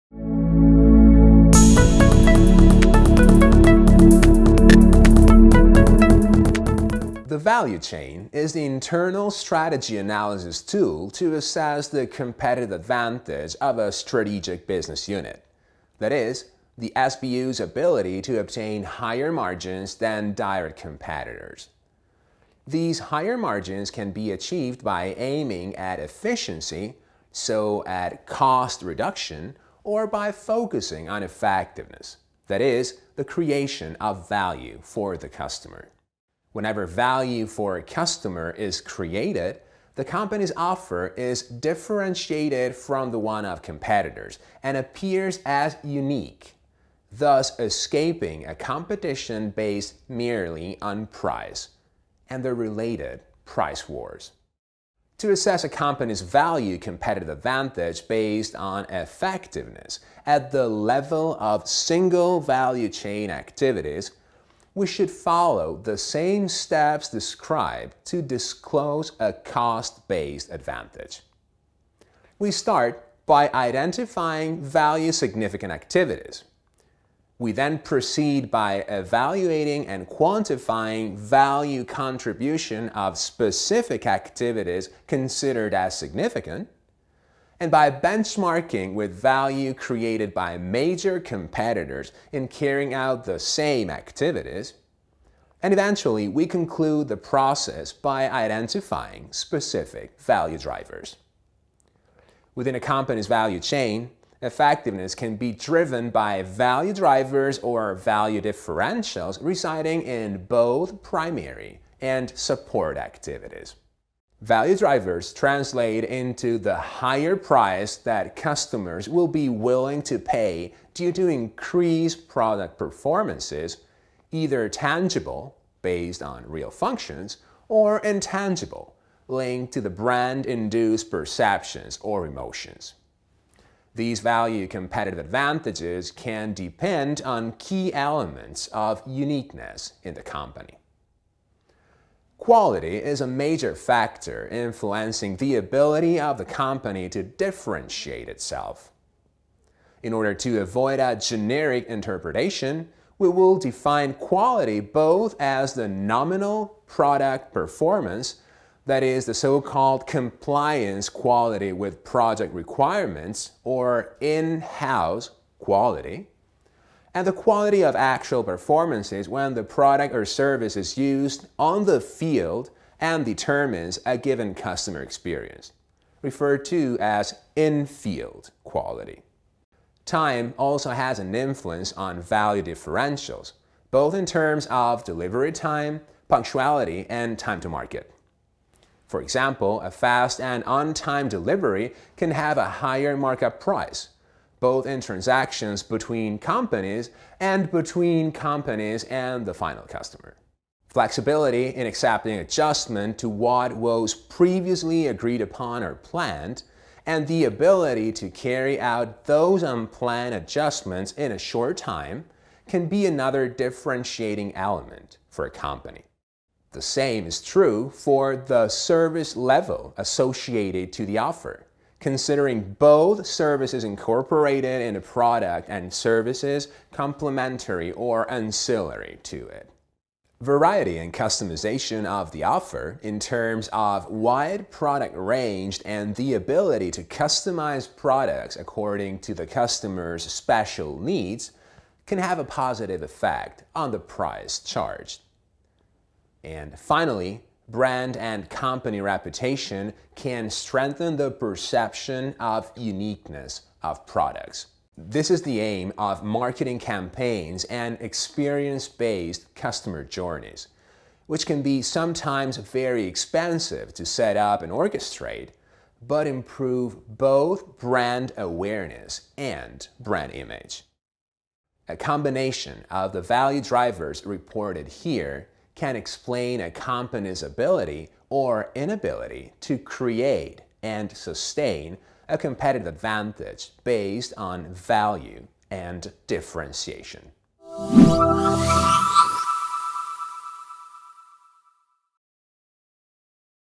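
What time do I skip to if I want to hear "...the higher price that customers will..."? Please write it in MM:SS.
01:56.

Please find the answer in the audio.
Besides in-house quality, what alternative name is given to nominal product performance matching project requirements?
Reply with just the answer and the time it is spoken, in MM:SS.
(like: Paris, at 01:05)
Compliance quality, at 02:40.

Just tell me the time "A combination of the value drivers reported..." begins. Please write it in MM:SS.
04:31.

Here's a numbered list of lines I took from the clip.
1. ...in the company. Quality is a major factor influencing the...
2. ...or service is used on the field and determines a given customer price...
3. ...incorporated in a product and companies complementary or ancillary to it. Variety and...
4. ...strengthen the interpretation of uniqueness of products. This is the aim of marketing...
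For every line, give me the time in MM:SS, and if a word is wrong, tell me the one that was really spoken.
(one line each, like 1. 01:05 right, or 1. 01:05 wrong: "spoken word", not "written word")
1. 02:20 right
2. 02:50 wrong: "experience", not "price"
3. 03:43 wrong: "services", not "companies"
4. 04:10 wrong: "perception", not "interpretation".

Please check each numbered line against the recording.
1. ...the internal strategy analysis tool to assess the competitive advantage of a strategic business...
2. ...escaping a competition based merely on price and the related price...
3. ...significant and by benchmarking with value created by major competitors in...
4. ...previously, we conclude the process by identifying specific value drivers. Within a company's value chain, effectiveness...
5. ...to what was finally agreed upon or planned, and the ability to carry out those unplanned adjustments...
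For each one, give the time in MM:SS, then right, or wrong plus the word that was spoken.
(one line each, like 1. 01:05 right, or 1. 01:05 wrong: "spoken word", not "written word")
1. 00:08 right
2. 00:47 right
3. 01:25 right
4. 01:35 wrong: "eventually", not "previously"
5. 03:23 wrong: "previously", not "finally".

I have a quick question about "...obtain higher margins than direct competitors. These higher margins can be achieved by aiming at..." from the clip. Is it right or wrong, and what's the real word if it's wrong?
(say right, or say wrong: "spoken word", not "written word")
right.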